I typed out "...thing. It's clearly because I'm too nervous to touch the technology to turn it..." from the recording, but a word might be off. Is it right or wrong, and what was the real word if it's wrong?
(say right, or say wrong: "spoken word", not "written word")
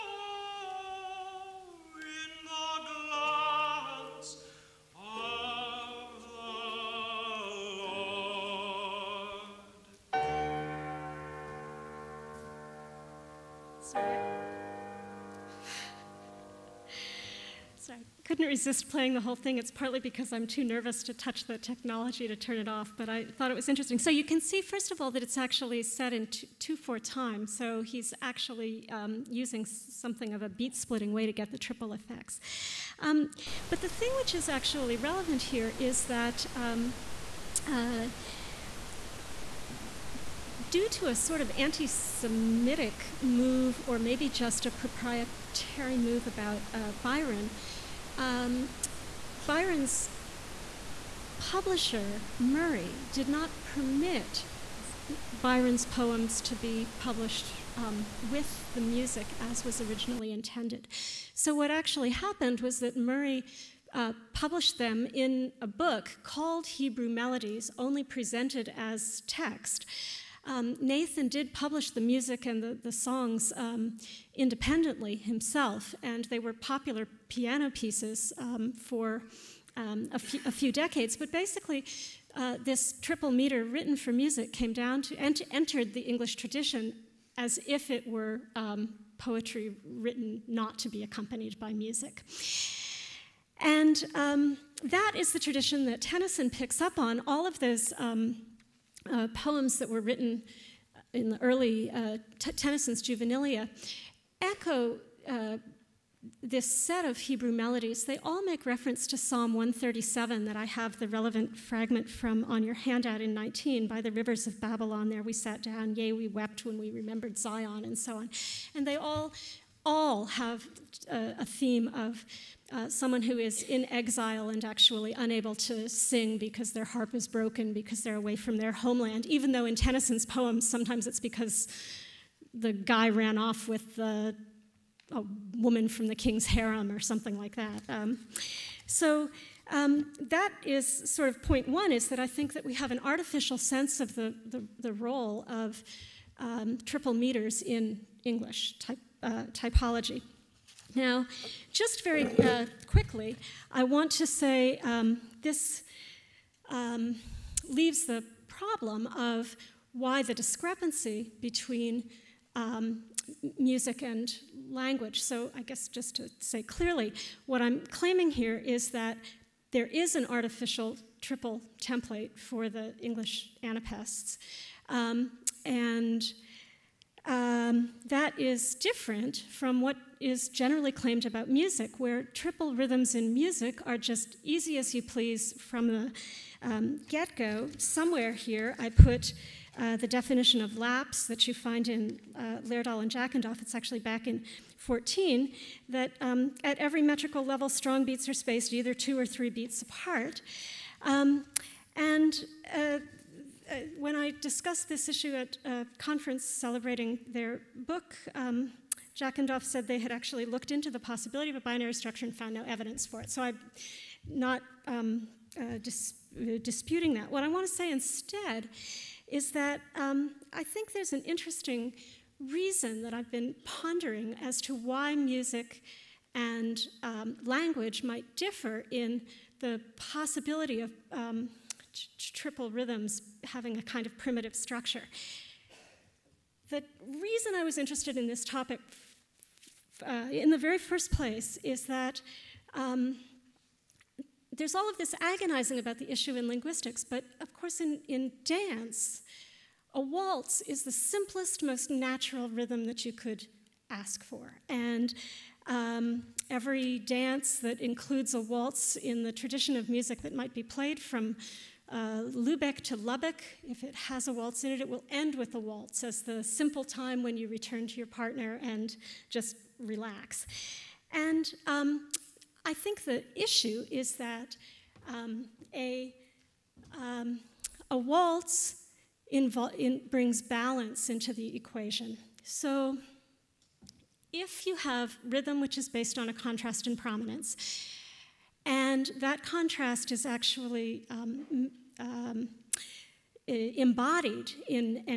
wrong: "partly", not "clearly".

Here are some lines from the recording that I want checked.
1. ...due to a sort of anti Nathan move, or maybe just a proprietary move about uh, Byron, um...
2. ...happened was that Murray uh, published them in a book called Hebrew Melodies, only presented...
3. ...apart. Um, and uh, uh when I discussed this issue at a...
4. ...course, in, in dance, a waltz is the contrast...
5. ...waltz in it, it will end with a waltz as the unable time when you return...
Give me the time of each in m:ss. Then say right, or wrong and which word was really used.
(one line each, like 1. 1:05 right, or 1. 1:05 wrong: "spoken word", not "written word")
1. 0:40 wrong: "Semitic", not "Nathan"
2. 1:02 right
3. 3:19 right
4. 4:07 wrong: "simplest", not "contrast"
5. 4:24 wrong: "simple", not "unable".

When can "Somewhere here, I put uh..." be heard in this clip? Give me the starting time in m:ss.
3:07.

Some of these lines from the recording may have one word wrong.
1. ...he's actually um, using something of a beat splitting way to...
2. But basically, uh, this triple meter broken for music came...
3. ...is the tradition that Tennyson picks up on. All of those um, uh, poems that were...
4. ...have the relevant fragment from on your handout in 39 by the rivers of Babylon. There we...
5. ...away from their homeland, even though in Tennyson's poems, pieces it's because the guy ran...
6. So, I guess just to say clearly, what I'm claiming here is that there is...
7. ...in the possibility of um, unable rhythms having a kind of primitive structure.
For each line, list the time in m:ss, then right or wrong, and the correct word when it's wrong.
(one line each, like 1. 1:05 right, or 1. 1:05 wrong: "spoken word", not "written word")
1. 0:27 right
2. 1:21 wrong: "written", not "broken"
3. 1:35 right
4. 1:50 wrong: "19", not "39"
5. 2:08 wrong: "sometimes", not "pieces"
6. 2:45 right
7. 3:48 wrong: "triple", not "unable".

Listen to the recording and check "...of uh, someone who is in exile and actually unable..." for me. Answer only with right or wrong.
right.